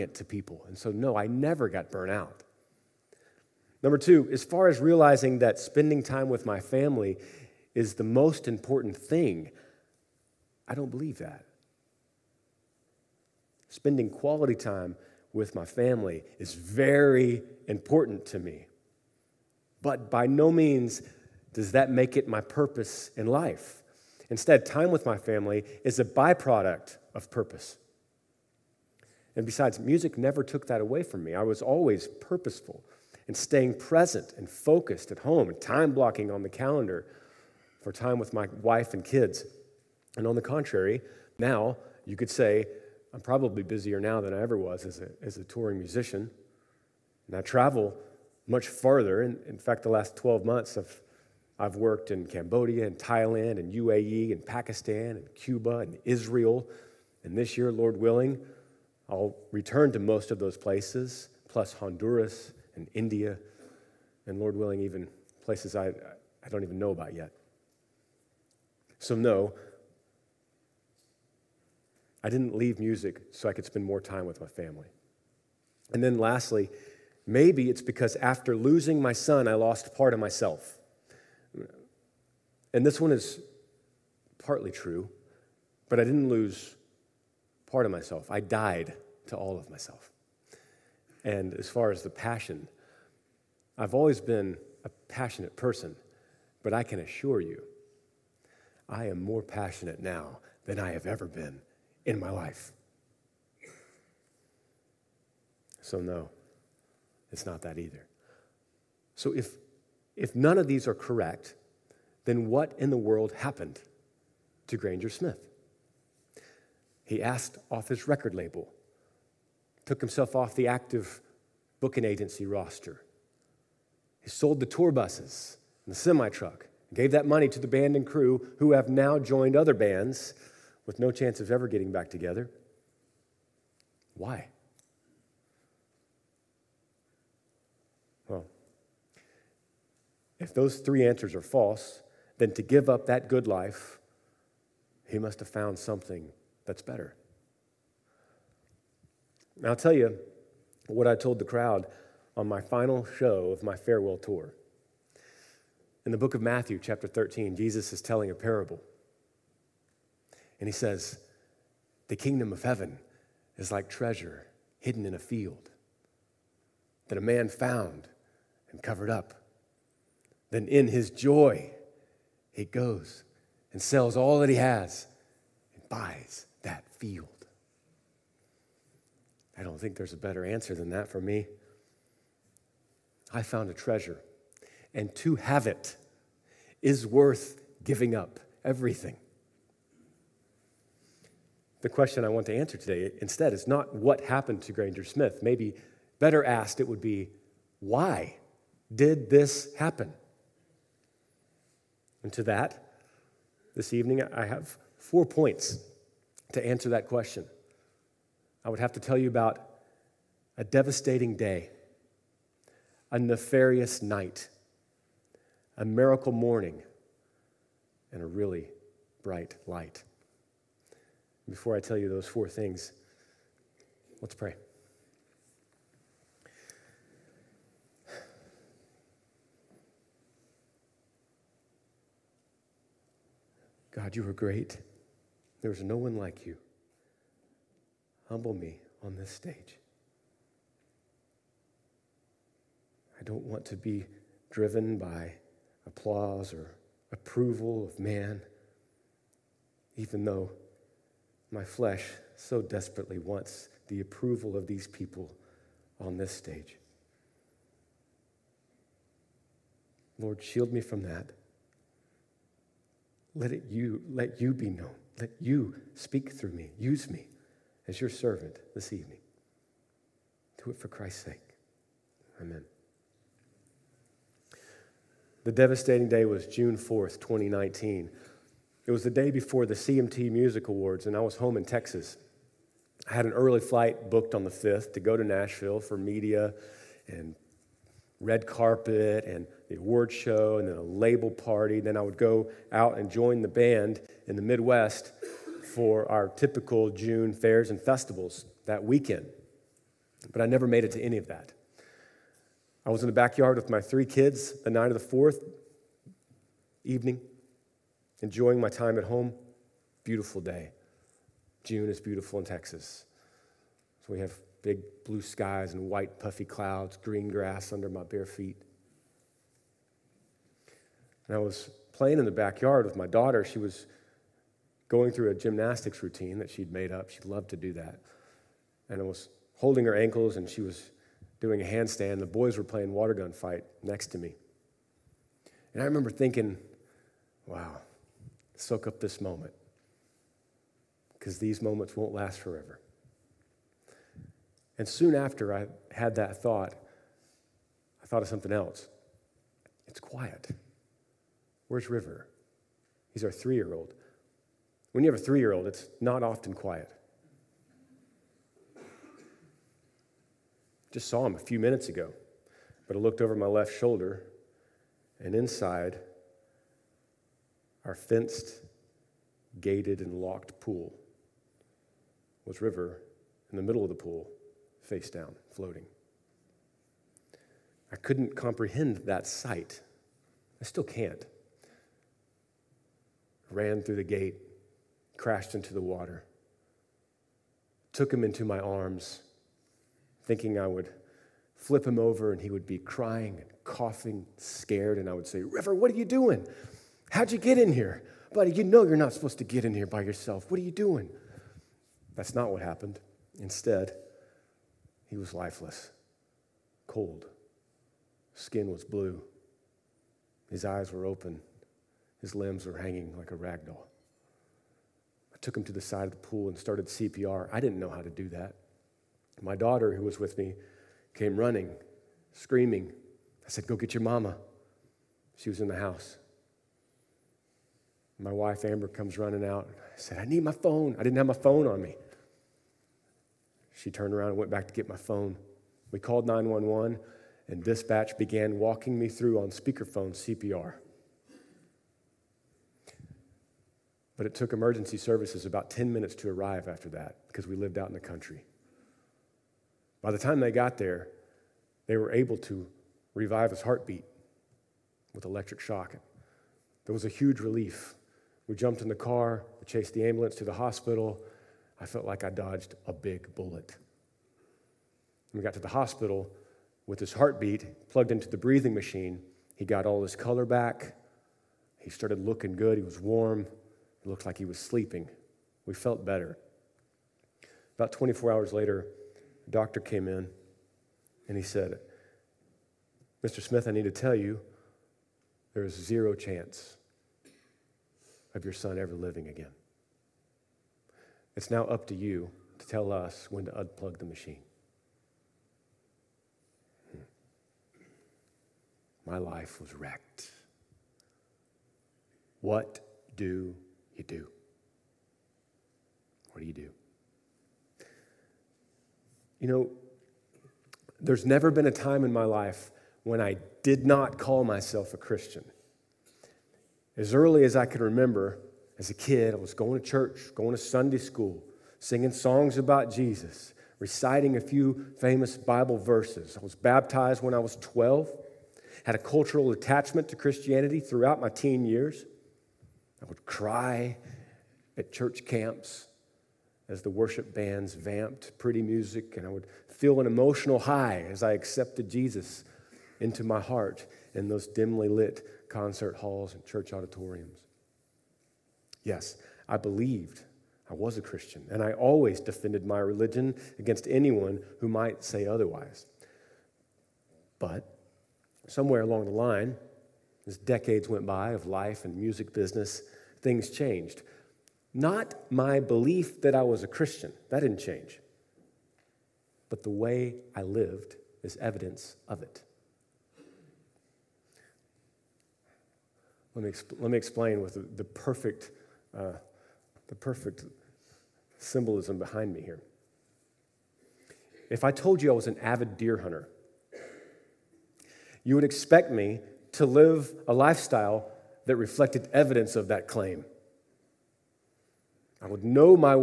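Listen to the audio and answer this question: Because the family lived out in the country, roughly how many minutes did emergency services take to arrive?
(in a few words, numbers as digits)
10.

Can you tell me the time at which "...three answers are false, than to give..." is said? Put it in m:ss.
2:20.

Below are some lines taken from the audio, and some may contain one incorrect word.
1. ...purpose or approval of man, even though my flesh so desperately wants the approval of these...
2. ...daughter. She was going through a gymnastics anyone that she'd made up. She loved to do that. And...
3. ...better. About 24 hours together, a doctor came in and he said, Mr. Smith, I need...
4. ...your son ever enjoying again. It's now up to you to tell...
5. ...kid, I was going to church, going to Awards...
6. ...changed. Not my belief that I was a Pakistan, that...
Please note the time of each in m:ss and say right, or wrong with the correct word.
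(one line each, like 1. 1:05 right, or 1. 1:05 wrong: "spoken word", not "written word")
1. 4:05 wrong: "applause", not "purpose"
2. 5:23 wrong: "routine", not "anyone"
3. 7:56 wrong: "later", not "together"
4. 8:08 wrong: "living", not "enjoying"
5. 8:38 wrong: "Sunday", not "Awards"
6. 9:23 wrong: "Christian", not "Pakistan".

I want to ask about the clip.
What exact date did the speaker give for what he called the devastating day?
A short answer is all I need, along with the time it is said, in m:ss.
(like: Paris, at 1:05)
June 4, 2019, at 4:36.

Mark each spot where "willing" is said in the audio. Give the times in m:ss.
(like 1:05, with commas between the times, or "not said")
0:57, 1:04.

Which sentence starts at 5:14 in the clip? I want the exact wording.
So we have big blue skies and white puffy clouds, green grass under my bare feet.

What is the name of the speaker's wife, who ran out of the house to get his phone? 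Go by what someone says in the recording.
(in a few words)
Amber.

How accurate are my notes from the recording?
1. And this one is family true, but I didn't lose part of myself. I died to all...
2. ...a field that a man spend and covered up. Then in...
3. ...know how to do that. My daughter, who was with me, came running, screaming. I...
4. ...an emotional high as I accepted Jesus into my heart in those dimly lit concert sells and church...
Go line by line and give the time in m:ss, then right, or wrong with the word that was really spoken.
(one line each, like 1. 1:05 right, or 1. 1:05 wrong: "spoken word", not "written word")
1. 1:22 wrong: "partly", not "family"
2. 2:45 wrong: "found", not "spend"
3. 6:57 right
4. 9:00 wrong: "halls", not "sells".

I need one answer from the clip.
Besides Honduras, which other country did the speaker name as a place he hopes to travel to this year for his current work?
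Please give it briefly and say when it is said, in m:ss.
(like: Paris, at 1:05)
India, at 1:02.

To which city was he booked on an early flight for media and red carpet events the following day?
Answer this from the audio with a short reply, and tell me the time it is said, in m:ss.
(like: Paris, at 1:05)
Nashville, at 4:45.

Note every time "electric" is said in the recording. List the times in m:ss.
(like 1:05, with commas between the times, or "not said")
7:35.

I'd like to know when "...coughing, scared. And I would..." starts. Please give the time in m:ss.
6:33.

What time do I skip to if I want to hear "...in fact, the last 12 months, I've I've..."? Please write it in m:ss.
0:49.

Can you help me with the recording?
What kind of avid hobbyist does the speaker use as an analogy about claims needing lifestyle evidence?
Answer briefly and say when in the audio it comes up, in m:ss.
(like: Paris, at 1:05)
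deer hunter, at 9:45.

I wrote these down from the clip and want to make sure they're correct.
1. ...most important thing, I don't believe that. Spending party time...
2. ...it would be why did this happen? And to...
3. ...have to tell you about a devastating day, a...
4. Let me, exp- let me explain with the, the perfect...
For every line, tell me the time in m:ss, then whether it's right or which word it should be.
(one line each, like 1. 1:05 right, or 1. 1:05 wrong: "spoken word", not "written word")
1. 0:08 wrong: "quality", not "party"
2. 3:16 right
3. 3:28 right
4. 9:36 right.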